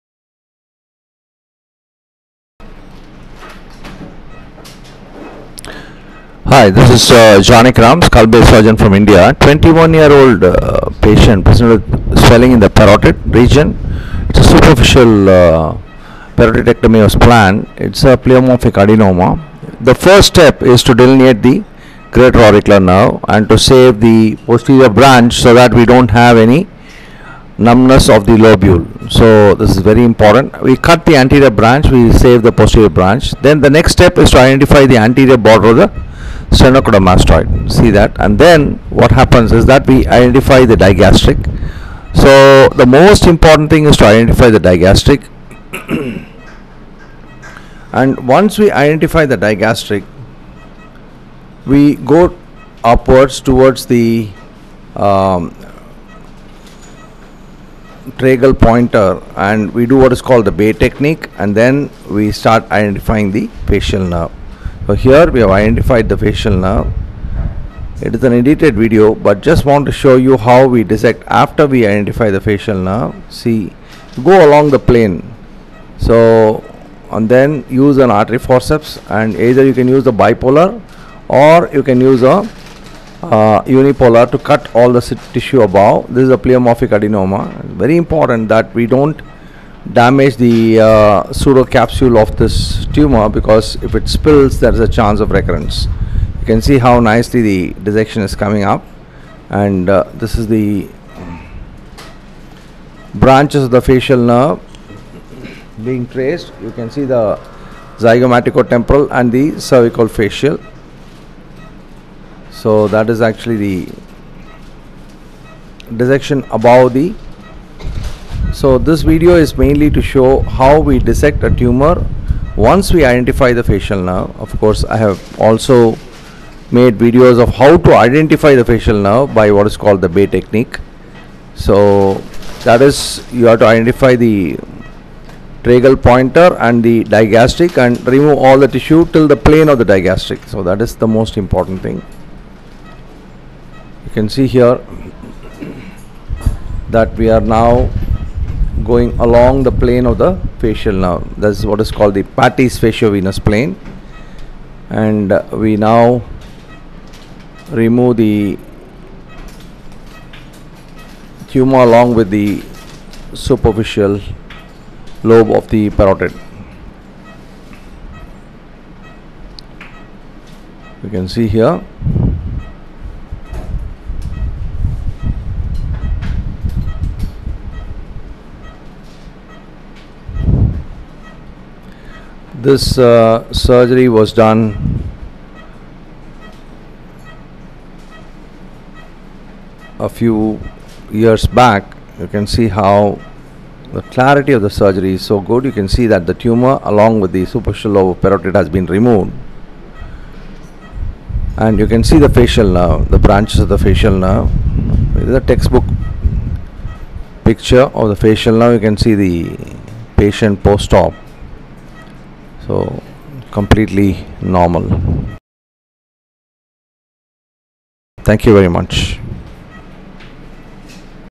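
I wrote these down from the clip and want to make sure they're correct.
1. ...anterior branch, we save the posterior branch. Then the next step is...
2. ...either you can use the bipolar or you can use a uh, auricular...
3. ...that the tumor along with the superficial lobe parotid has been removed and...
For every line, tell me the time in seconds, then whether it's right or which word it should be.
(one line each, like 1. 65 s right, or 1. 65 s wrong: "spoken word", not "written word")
1. 31 s right
2. 79 s wrong: "unipolar", not "auricular"
3. 196 s right.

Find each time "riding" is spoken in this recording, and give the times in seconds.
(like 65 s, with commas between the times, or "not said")
not said.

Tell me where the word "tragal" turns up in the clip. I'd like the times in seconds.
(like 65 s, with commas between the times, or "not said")
58 s, 135 s.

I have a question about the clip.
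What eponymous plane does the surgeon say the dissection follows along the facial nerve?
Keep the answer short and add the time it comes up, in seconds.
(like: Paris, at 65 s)
Patey's facial-venous plane, at 152 s.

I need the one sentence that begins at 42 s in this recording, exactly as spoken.
So the most important thing is to identify the digastric.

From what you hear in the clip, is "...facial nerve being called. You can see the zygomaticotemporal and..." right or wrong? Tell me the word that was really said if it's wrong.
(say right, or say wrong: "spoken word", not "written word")
wrong: "traced", not "called".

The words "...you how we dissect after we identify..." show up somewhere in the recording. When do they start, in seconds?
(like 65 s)
70 s.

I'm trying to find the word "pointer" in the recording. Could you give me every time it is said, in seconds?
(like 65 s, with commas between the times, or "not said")
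58 s, 136 s.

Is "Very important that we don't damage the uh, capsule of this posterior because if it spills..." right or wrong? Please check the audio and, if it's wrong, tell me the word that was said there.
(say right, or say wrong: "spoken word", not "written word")
wrong: "tumor", not "posterior".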